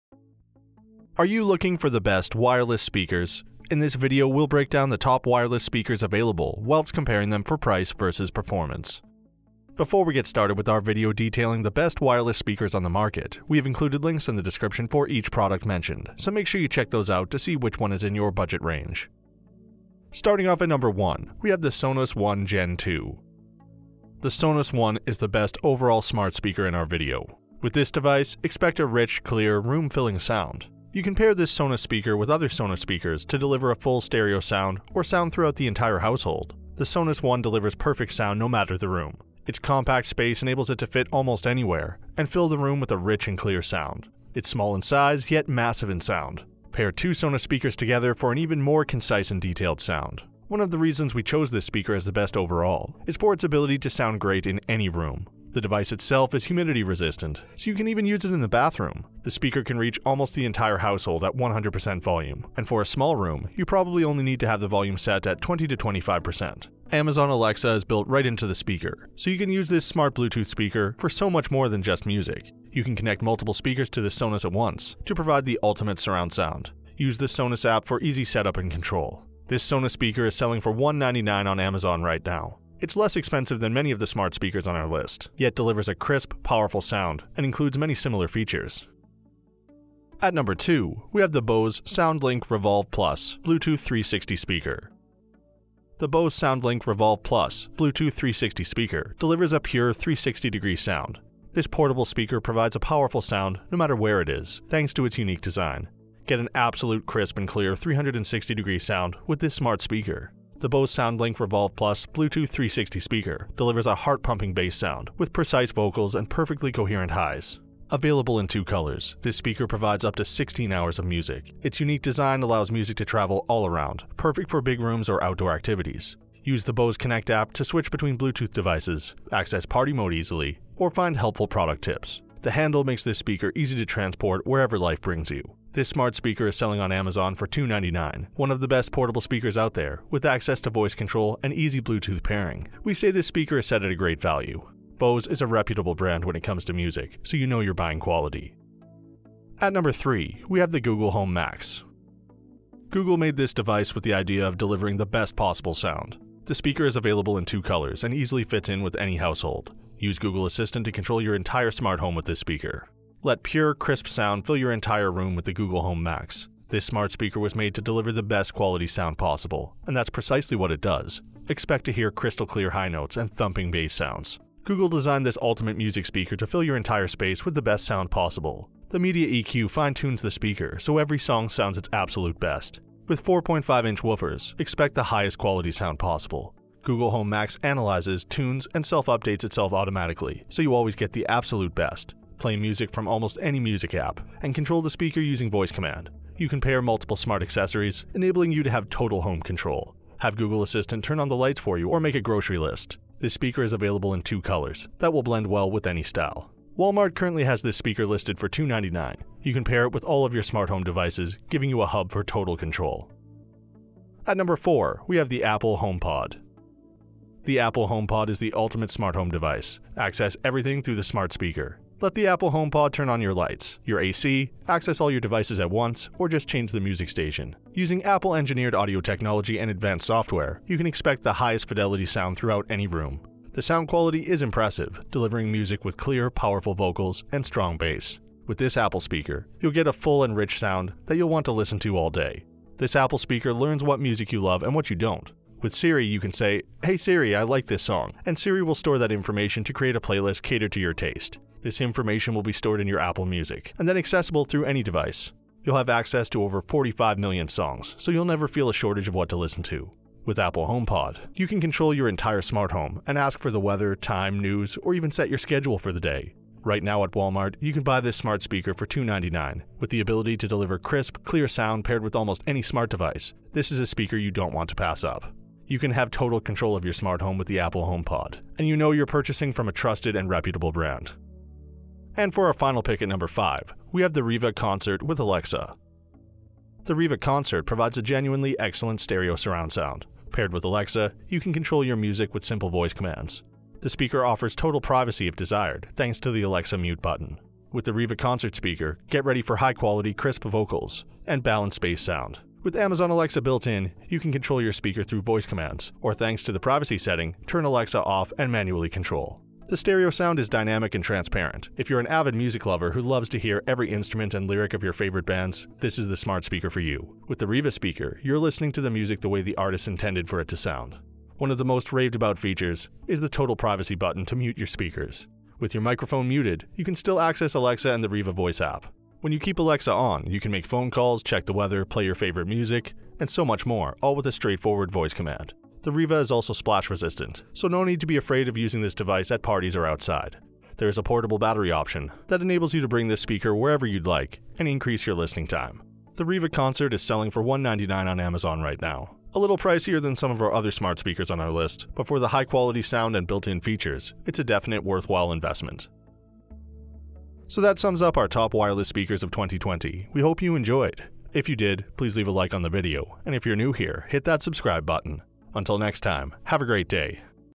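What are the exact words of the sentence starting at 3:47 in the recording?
Using Apple engineered audio technology and advanced software, you can expect the highest fidelity sound throughout any room.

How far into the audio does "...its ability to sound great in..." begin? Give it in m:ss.
0:53.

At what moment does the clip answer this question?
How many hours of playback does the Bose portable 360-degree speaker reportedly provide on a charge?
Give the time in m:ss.
2:00.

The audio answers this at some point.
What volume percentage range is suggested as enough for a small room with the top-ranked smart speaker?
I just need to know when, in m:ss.
1:05.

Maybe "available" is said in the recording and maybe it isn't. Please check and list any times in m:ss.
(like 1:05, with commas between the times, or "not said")
0:06, 1:57, 2:36, 3:23.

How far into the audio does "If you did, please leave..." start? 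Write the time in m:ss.
6:01.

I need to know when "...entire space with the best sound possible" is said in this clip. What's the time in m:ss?
2:56.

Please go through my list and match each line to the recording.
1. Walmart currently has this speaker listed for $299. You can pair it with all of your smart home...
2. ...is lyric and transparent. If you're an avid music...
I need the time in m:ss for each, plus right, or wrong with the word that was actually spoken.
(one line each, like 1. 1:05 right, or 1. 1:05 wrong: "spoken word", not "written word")
1. 3:26 right
2. 5:10 wrong: "dynamic", not "lyric".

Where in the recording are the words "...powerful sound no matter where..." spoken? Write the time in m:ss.
1:42.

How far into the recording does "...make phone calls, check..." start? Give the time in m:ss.
5:30.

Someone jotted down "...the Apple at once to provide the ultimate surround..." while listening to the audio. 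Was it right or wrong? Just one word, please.
wrong.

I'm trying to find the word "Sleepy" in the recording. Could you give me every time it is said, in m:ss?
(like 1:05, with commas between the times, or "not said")
not said.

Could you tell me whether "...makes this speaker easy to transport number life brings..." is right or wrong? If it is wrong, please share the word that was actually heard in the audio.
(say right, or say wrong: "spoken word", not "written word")
wrong: "wherever", not "number".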